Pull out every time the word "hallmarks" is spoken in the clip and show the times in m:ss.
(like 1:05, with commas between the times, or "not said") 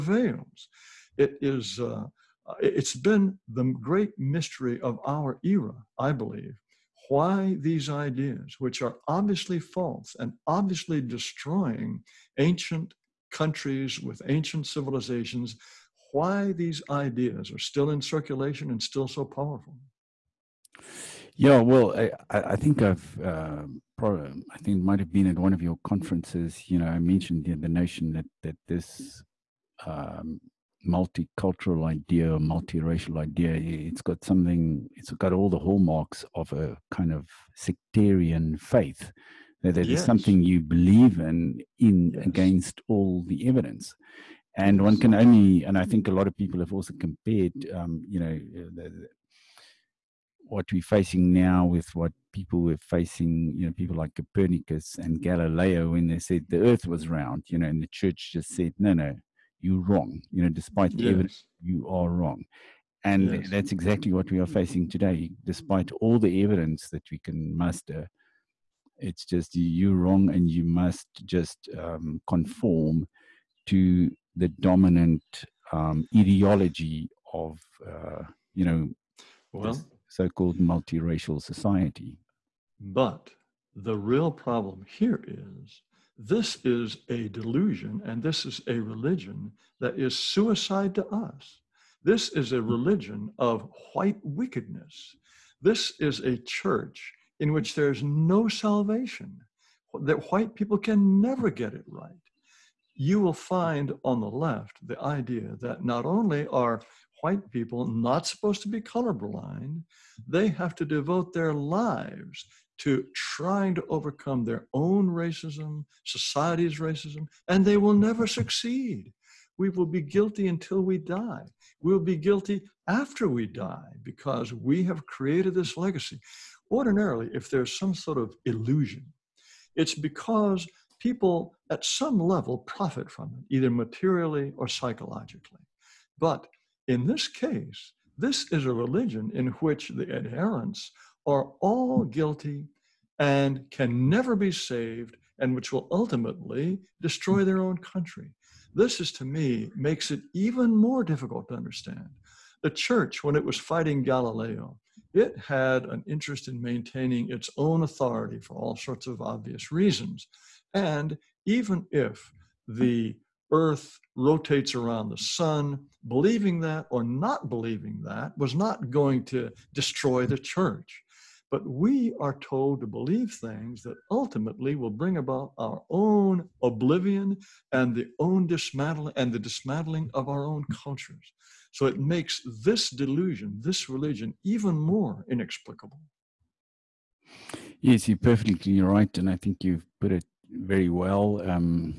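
0:35.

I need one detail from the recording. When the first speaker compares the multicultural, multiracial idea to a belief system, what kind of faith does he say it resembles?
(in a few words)
sectarian faith.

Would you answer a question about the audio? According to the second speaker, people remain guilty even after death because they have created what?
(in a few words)
legacy.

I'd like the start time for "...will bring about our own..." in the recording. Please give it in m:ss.
2:54.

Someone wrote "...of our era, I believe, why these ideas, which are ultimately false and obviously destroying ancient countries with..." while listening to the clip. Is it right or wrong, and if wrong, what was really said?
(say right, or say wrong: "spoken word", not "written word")
wrong: "obviously", not "ultimately".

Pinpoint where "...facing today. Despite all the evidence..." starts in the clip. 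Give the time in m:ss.
1:04.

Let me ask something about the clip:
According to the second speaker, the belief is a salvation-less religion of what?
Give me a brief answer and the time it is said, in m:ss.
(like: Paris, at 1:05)
white wickedness, at 1:33.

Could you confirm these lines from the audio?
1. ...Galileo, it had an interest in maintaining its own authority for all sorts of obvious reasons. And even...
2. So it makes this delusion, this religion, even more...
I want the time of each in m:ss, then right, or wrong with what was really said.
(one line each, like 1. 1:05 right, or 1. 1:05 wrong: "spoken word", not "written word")
1. 2:34 right
2. 3:01 right.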